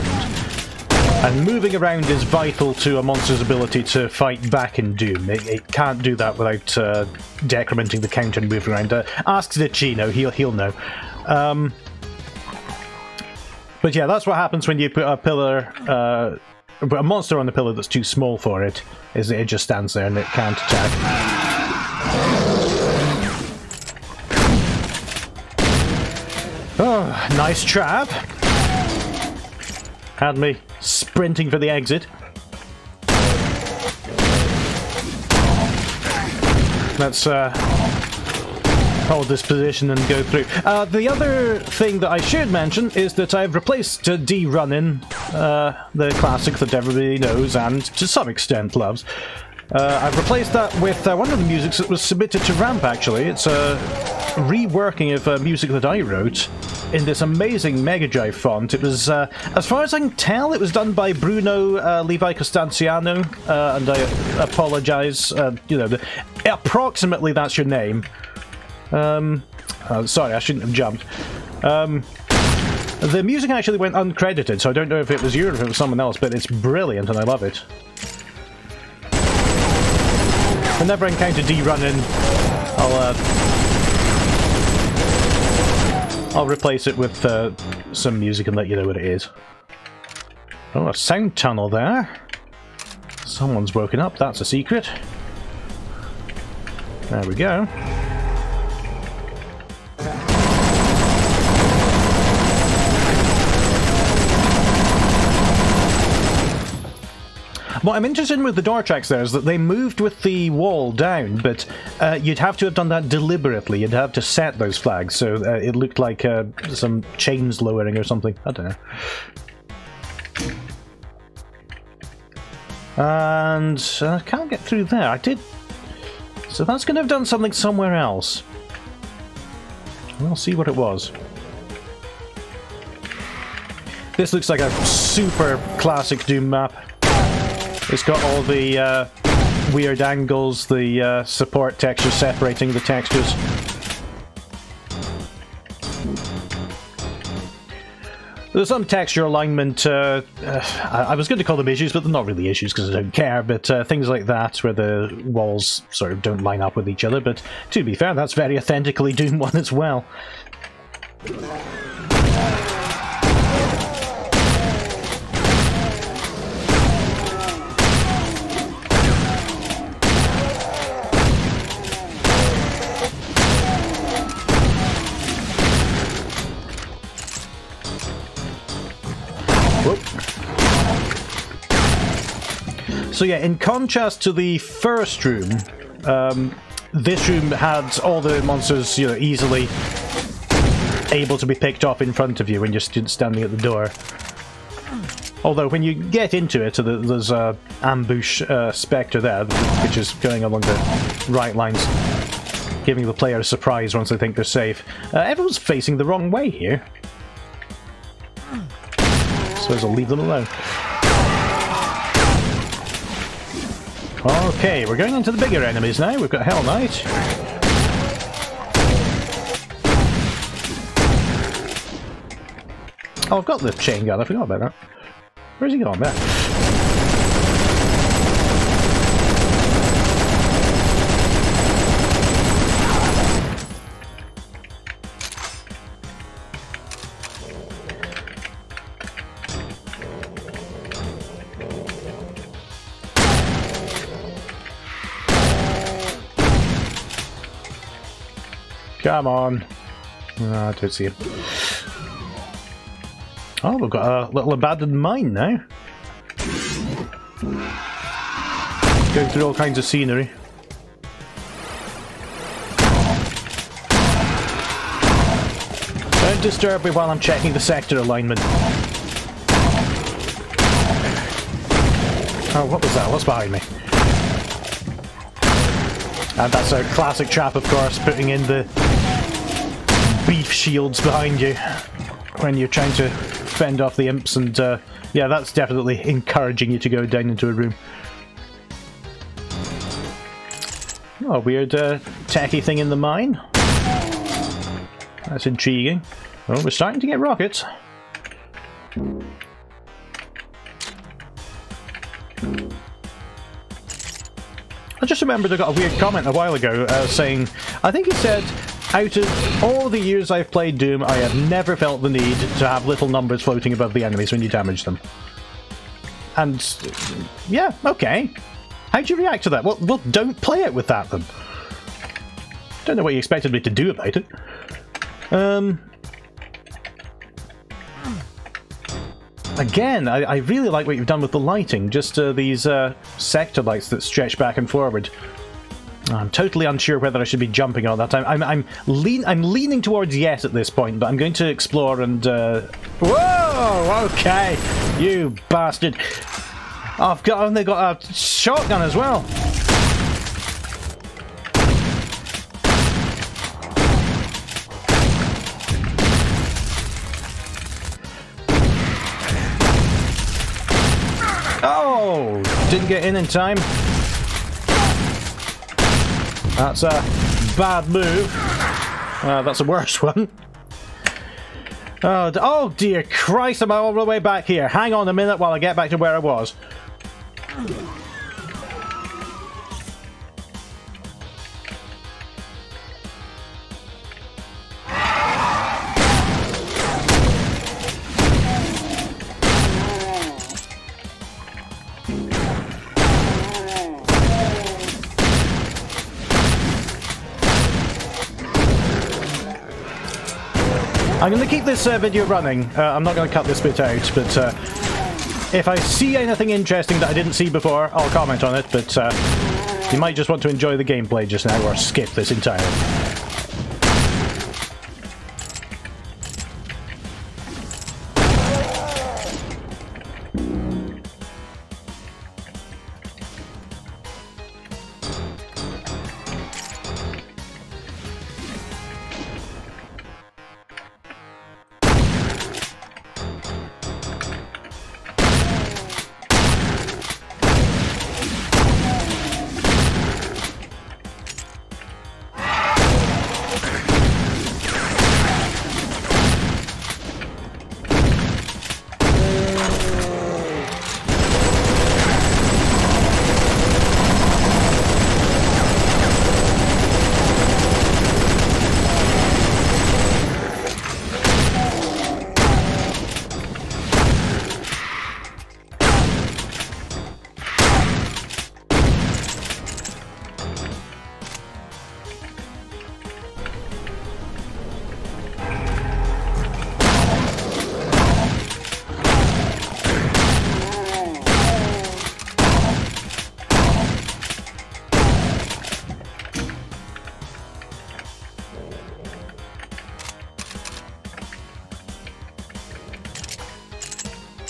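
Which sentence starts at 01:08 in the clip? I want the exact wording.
Um, uh, sorry, I shouldn't have jumped.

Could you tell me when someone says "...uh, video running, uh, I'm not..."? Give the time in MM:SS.
06:41.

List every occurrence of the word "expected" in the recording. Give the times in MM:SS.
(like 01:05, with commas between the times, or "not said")
05:23.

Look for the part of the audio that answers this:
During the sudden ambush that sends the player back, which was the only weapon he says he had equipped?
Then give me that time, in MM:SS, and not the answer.
05:48.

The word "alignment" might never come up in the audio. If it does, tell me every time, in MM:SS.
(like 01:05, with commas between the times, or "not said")
02:29, 04:27.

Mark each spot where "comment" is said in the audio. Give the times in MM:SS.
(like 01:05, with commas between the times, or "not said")
05:05, 06:48.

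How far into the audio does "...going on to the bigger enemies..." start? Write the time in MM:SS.
03:34.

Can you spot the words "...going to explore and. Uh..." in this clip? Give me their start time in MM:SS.
05:41.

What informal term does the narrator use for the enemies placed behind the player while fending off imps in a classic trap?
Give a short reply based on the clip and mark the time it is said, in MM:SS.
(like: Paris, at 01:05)
Beef shields, at 04:40.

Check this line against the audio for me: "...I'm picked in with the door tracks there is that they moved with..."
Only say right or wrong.
wrong.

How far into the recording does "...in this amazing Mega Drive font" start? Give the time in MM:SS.
00:56.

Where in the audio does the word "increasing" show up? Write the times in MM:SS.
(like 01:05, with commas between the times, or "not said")
not said.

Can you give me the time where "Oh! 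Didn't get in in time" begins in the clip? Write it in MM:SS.
06:01.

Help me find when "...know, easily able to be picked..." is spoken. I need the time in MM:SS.
03:09.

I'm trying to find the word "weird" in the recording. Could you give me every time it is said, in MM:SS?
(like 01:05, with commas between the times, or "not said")
02:19, 04:51, 05:05.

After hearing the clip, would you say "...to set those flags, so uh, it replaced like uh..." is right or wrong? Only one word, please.
wrong.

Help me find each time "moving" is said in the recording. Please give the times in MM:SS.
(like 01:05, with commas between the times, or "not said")
00:01, 00:08.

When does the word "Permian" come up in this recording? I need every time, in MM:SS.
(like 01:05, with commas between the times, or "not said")
not said.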